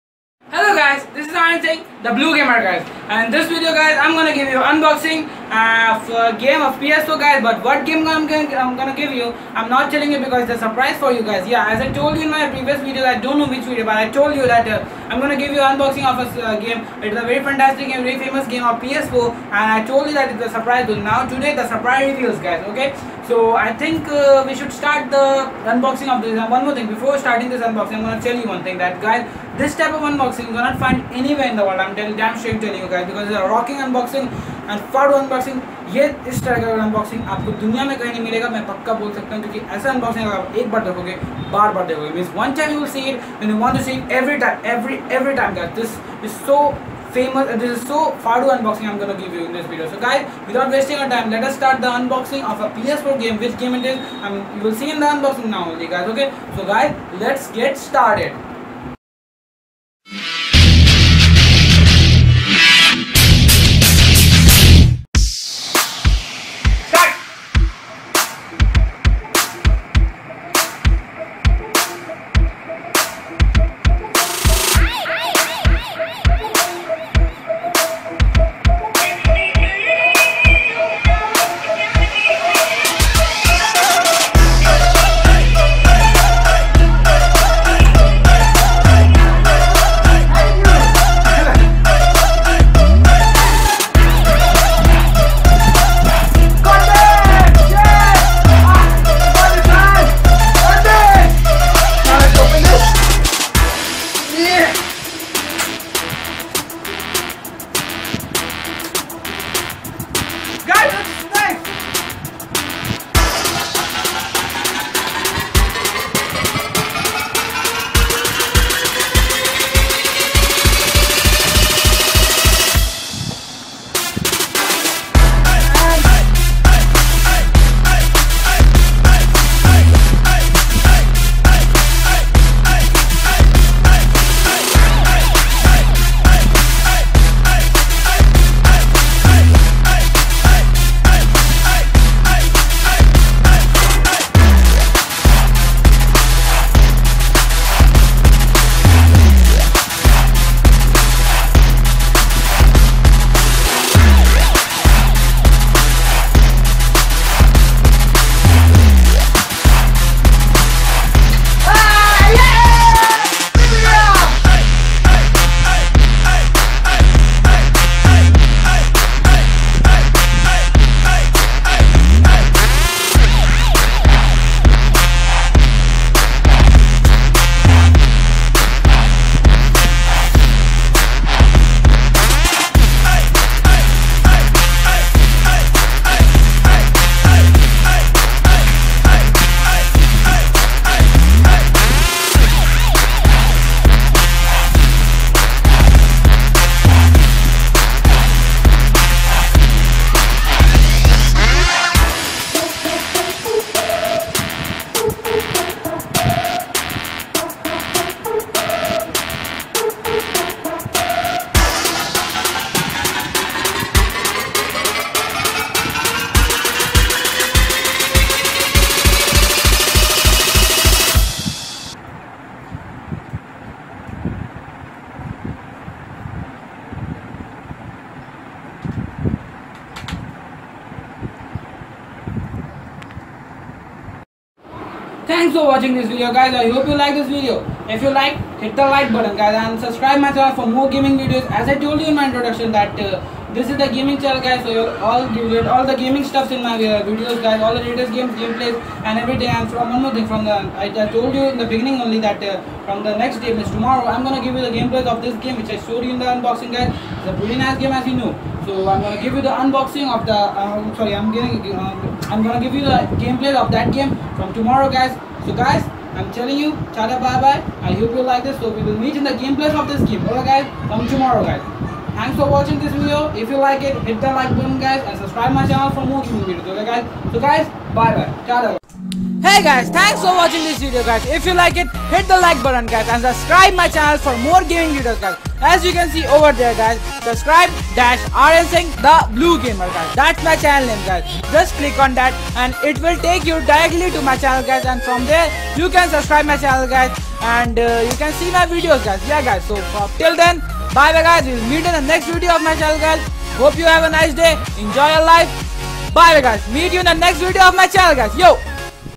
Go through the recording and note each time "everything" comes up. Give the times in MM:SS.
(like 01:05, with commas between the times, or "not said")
04:09.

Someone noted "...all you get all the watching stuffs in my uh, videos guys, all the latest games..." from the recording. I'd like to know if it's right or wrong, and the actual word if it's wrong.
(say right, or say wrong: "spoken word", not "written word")
wrong: "gaming", not "watching".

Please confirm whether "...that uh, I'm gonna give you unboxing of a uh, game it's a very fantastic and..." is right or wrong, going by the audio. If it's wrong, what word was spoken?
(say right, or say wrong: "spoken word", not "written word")
right.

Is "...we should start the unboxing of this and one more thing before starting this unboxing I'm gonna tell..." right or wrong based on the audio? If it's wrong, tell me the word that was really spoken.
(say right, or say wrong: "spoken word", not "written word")
right.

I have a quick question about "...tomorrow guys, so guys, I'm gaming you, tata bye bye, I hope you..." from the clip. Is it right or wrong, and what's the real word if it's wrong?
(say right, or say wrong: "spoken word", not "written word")
wrong: "telling", not "gaming".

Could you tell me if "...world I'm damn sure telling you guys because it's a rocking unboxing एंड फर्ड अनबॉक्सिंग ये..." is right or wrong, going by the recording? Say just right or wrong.
right.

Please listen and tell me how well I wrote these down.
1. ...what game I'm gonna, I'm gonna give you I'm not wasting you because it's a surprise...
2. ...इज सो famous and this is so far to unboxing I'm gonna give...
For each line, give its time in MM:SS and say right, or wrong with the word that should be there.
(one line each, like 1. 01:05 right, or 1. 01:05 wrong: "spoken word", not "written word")
1. 00:07 wrong: "telling", not "wasting"
2. 00:46 right.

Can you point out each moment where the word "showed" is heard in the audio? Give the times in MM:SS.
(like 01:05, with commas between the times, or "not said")
04:15.